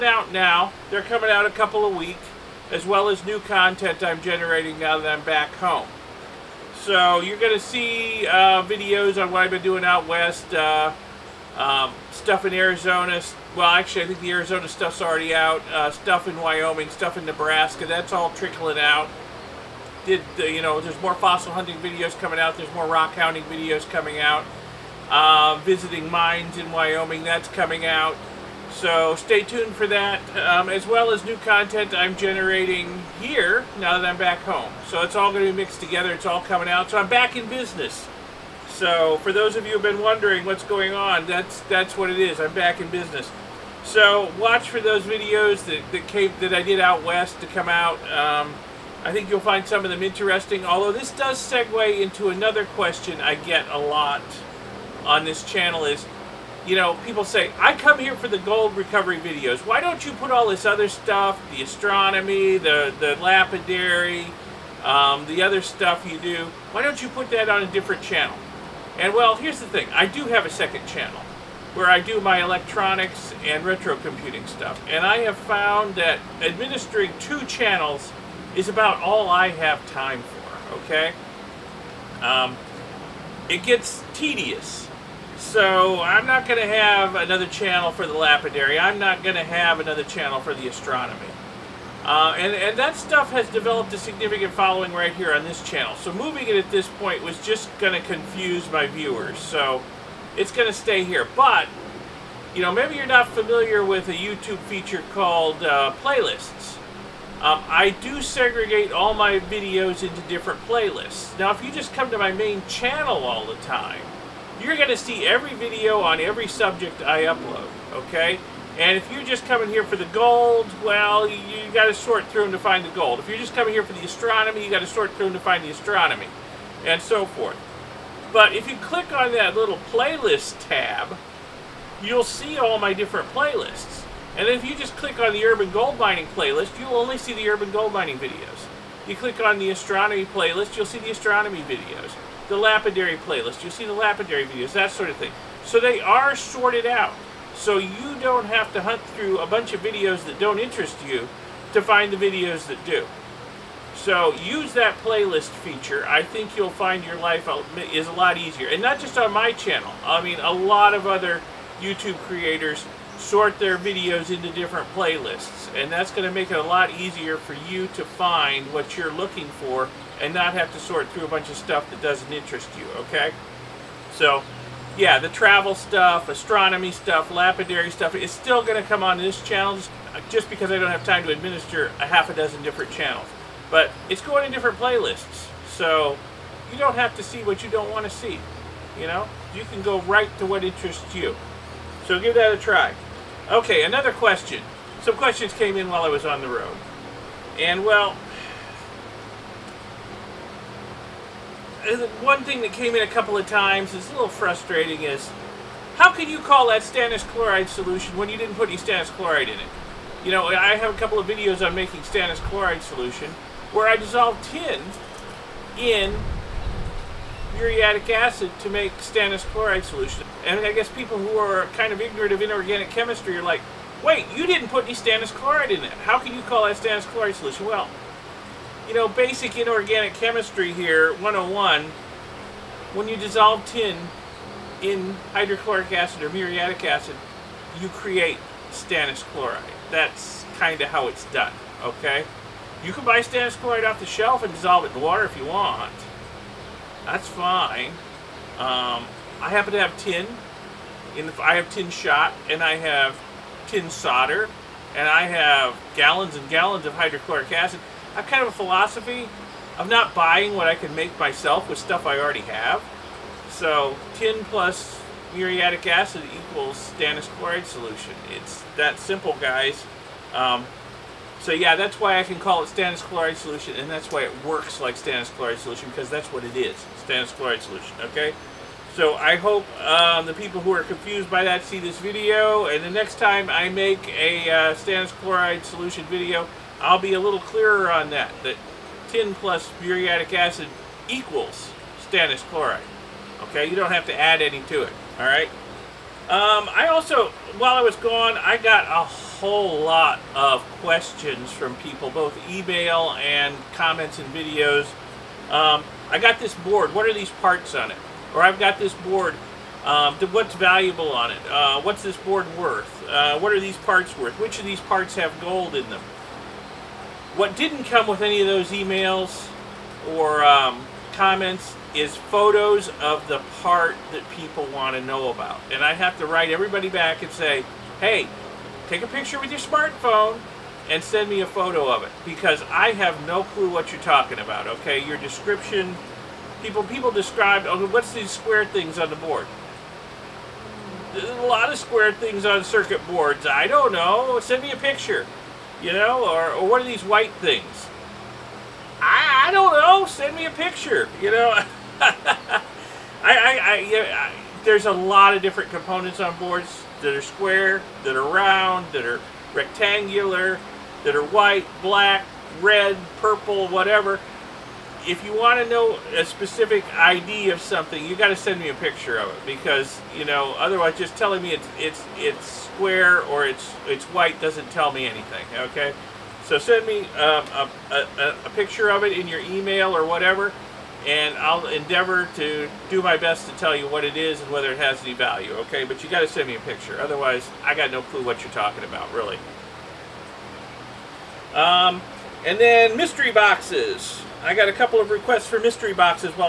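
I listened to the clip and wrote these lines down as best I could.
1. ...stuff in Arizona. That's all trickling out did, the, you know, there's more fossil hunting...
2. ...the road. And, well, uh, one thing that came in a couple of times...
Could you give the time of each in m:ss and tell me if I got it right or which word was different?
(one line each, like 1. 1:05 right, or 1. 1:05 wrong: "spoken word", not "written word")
1. 0:16 wrong: "Nebraska", not "Arizona"
2. 3:16 right.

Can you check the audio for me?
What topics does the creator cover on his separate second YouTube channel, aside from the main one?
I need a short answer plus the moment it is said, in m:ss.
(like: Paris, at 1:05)
electronics and retro computing, at 1:12.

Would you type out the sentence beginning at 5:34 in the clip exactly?
Okay, your description, people people describe.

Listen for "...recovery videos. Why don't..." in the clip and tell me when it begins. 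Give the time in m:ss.
0:58.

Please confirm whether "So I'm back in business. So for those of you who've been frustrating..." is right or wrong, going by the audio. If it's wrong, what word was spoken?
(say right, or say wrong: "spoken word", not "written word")
wrong: "wondering", not "frustrating".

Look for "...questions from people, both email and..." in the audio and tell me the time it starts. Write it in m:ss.
5:00.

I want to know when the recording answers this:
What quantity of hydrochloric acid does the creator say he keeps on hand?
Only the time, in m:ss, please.
4:15.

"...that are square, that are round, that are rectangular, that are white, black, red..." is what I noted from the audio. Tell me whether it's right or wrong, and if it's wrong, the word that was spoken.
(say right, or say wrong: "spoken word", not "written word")
right.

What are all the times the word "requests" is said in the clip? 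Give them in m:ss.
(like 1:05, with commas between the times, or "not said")
6:35.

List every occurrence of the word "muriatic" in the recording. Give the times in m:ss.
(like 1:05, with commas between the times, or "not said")
3:37, 3:56, 4:25, 4:49.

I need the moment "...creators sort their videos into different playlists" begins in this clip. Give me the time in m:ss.
2:42.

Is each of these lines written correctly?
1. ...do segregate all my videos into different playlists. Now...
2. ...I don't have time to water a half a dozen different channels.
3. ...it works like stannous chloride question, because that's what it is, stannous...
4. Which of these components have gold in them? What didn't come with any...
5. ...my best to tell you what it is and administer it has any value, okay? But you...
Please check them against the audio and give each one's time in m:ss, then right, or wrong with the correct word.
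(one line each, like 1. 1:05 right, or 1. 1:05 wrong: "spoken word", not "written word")
1. 1:47 right
2. 3:00 wrong: "administer", not "water"
3. 4:34 wrong: "solution", not "question"
4. 5:14 wrong: "parts", not "components"
5. 6:23 wrong: "whether", not "administer".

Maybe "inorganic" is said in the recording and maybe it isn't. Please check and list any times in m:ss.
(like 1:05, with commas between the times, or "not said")
3:42, 3:49.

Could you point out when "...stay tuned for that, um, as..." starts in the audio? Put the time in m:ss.
0:29.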